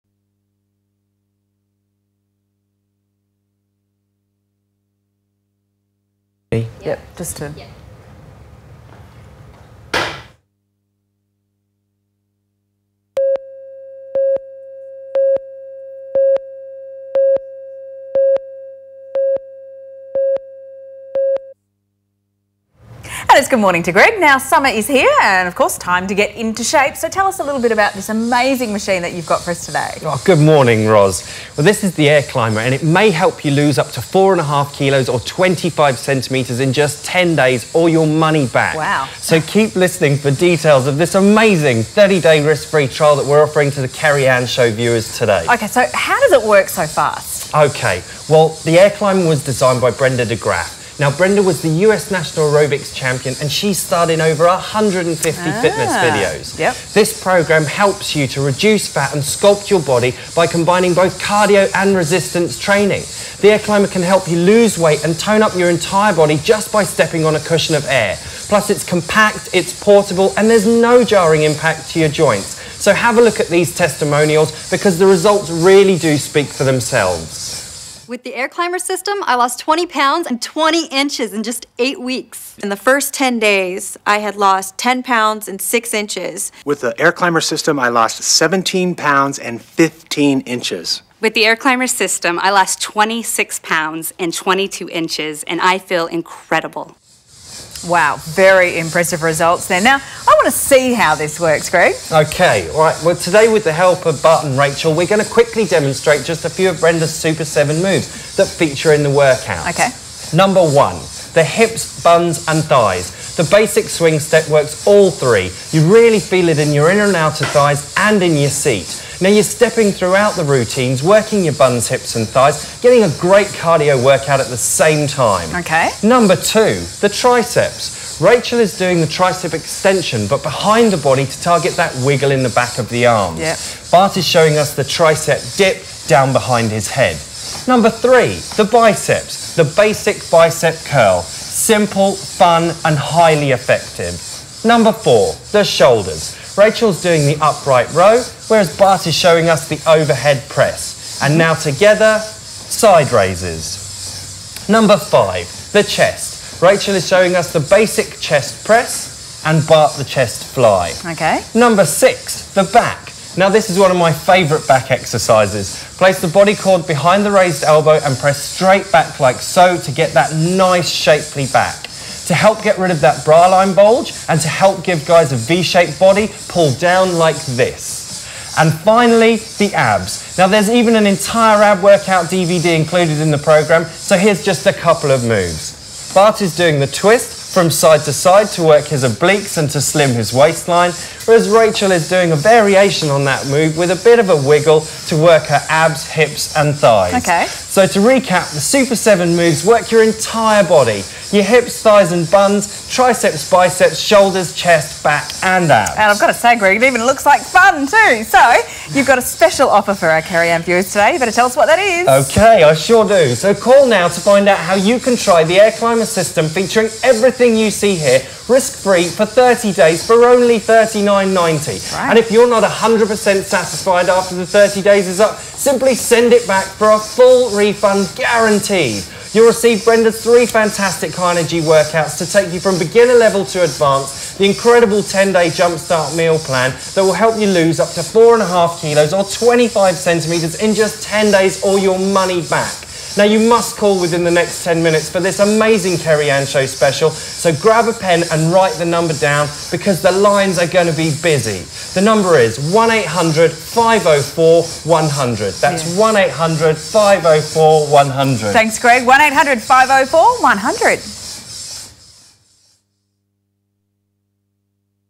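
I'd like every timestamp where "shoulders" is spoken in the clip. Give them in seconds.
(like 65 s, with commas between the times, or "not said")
145 s, 203 s.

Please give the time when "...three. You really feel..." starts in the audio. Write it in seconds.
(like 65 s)
115 s.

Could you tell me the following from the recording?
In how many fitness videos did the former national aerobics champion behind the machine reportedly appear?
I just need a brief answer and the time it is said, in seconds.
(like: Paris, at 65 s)
over 150, at 54 s.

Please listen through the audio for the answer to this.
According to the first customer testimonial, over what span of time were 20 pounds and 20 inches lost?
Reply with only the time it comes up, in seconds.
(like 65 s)
81 s.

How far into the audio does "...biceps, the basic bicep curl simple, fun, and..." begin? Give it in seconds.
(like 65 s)
138 s.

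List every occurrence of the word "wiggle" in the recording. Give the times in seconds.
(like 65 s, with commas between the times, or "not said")
132 s, 194 s.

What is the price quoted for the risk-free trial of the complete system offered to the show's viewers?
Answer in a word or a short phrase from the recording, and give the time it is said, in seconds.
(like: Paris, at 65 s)
$39.90, at 220 s.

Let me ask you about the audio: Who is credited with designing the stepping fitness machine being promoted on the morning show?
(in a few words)
Brenda Dygraf.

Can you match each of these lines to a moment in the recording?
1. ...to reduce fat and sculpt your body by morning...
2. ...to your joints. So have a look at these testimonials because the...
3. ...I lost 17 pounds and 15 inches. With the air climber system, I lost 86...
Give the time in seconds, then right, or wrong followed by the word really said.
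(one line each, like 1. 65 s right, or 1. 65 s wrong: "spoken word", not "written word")
1. 58 s wrong: "combining", not "morning"
2. 71 s right
3. 87 s wrong: "26", not "86".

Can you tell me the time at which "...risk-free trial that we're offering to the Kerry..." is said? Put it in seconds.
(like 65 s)
42 s.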